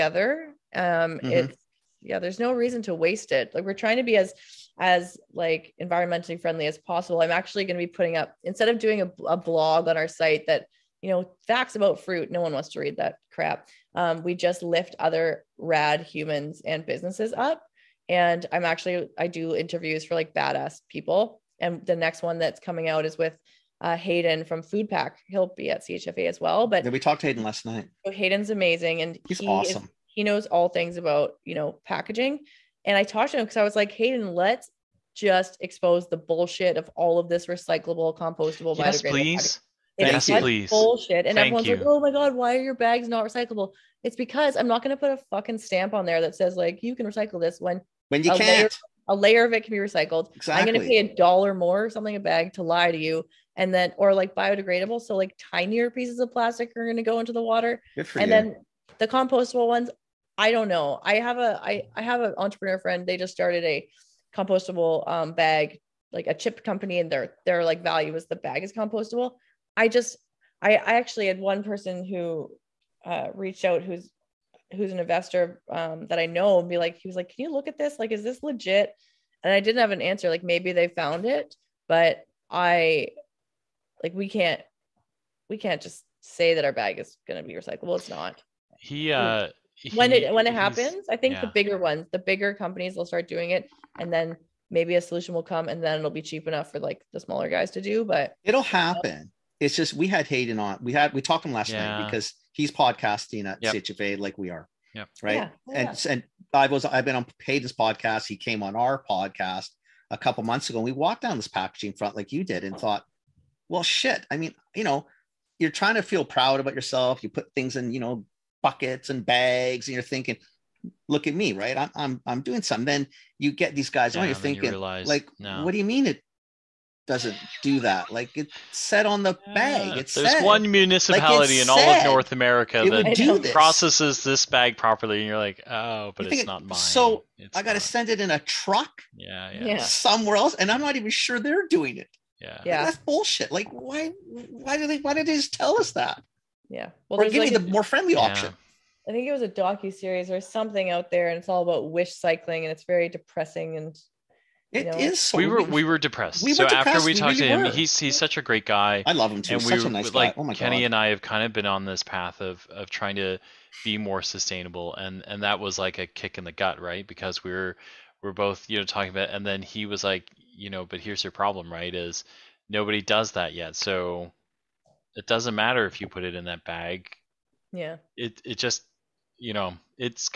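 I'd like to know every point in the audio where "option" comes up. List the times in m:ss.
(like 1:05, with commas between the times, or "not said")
2:28.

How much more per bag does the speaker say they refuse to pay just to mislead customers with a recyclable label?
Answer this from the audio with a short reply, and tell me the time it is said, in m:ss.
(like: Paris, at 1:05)
a dollar, at 0:50.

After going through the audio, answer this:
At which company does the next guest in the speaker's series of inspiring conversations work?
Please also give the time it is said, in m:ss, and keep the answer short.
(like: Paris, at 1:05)
Food Pack, at 0:24.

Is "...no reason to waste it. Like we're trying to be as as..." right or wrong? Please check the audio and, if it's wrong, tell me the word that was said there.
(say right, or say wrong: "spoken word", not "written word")
right.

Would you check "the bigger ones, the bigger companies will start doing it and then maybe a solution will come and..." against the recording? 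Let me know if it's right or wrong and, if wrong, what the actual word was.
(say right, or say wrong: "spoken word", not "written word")
right.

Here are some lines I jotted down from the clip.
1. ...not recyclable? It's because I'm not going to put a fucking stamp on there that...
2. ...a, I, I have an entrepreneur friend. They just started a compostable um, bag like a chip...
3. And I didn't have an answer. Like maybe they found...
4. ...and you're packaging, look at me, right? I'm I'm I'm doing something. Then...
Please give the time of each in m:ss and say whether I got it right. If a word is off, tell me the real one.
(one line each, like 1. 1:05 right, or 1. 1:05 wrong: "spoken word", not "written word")
1. 0:43 right
2. 1:01 right
3. 1:19 right
4. 1:59 wrong: "thinking", not "packaging".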